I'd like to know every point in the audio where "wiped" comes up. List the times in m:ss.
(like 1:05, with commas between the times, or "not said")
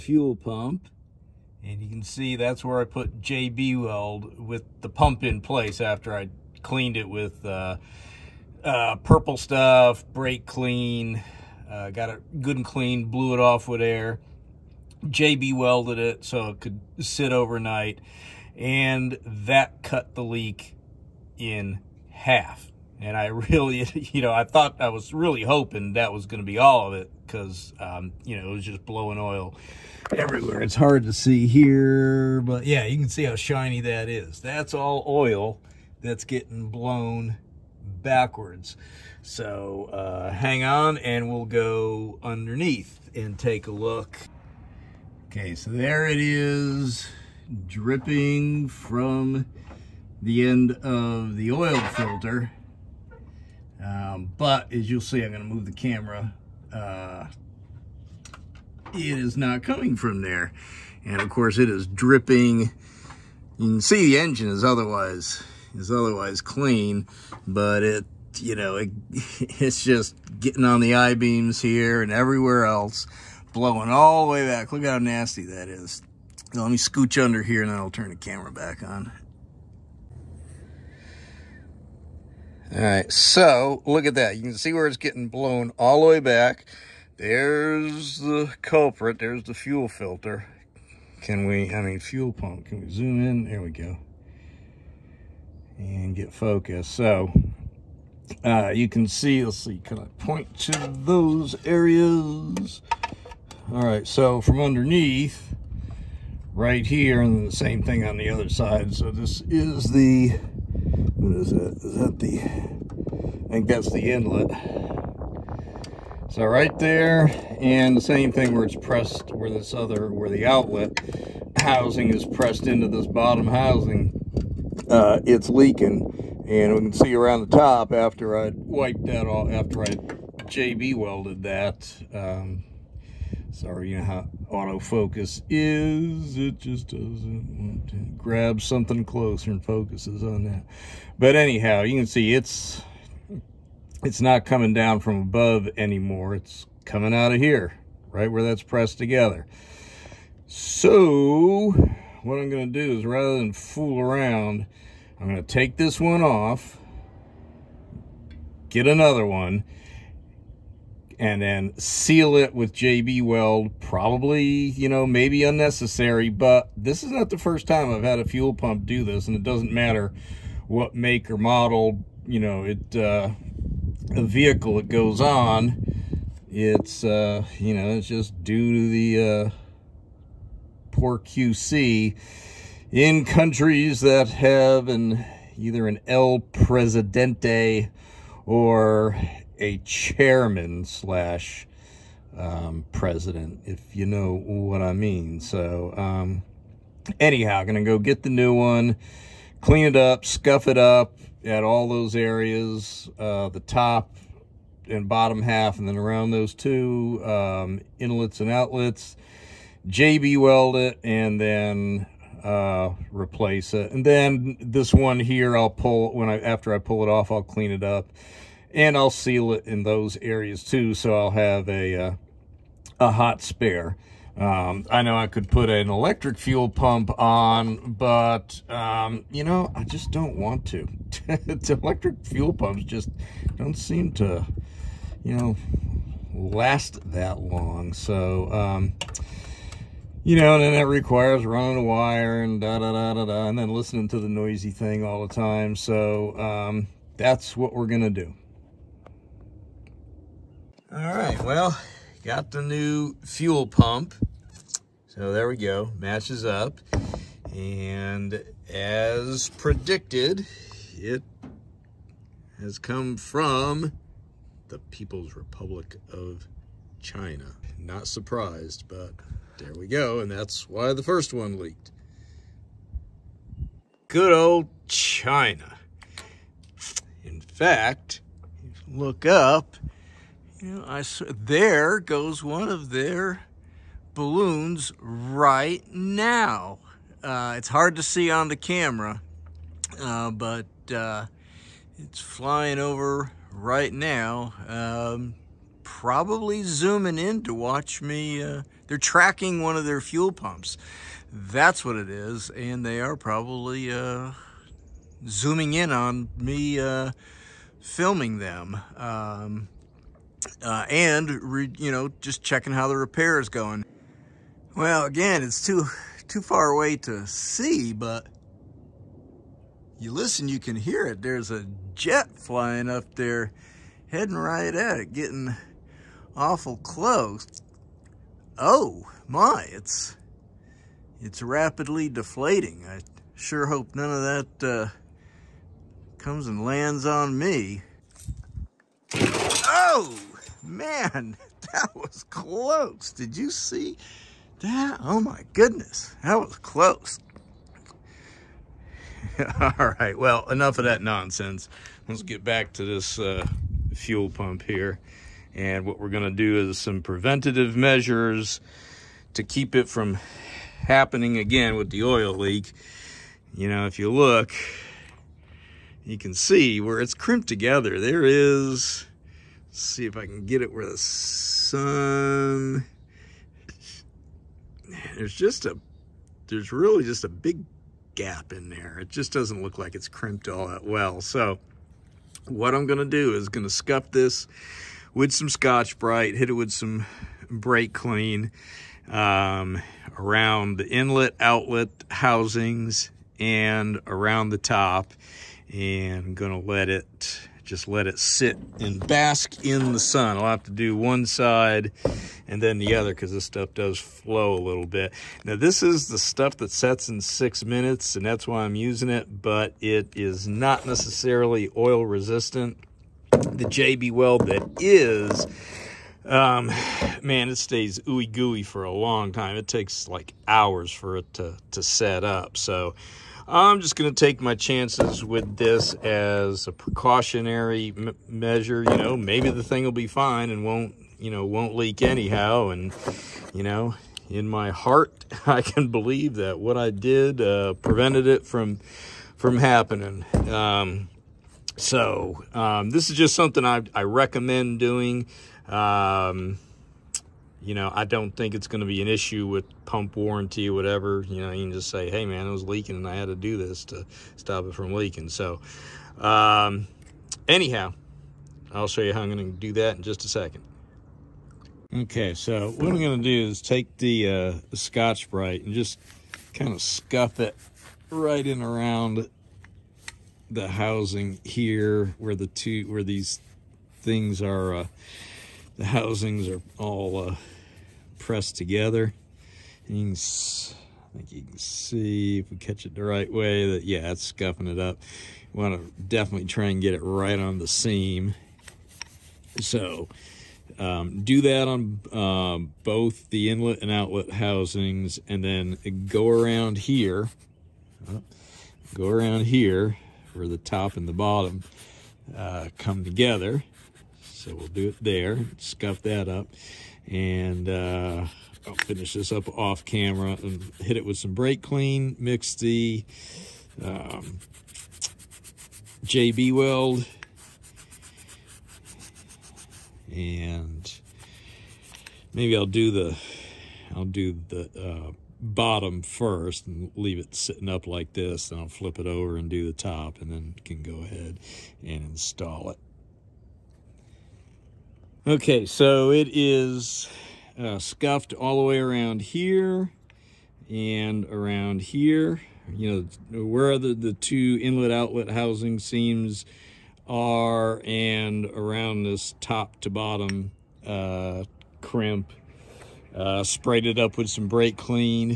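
2:08.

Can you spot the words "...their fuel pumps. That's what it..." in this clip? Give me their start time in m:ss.
4:59.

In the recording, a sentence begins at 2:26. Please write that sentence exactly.
It's coming out of here, right where that's pressed together.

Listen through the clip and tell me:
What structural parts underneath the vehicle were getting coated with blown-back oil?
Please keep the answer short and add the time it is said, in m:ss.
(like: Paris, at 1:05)
I-beams, at 1:10.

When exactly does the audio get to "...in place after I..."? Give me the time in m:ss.
0:05.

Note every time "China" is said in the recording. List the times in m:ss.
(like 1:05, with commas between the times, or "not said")
4:27, 4:34.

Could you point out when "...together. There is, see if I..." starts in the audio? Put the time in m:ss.
6:07.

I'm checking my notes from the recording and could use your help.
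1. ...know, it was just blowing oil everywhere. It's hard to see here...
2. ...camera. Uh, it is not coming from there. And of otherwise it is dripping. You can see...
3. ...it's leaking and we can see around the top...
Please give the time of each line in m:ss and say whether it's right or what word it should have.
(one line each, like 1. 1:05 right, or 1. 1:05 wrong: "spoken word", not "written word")
1. 0:28 right
2. 0:55 wrong: "course", not "otherwise"
3. 2:05 right.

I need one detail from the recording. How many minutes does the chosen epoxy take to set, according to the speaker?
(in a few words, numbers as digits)
6.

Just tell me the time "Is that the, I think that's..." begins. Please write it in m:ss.
1:51.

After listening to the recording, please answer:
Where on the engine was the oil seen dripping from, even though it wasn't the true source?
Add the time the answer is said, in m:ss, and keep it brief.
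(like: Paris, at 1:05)
The oil filter, at 0:50.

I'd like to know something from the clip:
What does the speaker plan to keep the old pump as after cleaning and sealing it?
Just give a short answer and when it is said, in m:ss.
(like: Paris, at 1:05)
A hot spare, at 3:43.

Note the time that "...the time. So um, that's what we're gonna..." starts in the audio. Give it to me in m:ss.
4:05.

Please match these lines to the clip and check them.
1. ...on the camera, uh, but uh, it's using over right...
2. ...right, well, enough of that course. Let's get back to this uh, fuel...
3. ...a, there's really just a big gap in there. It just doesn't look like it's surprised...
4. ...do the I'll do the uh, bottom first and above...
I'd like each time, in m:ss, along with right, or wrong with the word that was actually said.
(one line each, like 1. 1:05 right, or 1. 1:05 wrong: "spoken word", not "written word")
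1. 4:48 wrong: "flying", not "using"
2. 5:49 wrong: "nonsense", not "course"
3. 6:15 wrong: "crimped", not "surprised"
4. 8:42 wrong: "leave", not "above".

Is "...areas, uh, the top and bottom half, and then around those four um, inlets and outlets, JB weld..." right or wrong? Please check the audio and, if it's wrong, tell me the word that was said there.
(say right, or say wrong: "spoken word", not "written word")
wrong: "two", not "four".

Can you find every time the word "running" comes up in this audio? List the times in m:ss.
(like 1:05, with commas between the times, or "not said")
4:01.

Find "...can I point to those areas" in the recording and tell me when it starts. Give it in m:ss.
1:39.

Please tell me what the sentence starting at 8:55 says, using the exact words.
Okay, so it is uh, scuffed all the way around here and around here.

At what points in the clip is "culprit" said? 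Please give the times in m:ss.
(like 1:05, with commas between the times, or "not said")
1:28.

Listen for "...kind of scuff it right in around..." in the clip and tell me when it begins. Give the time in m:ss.
7:46.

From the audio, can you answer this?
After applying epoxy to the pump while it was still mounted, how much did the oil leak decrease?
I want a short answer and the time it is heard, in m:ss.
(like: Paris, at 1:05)
In half, at 0:19.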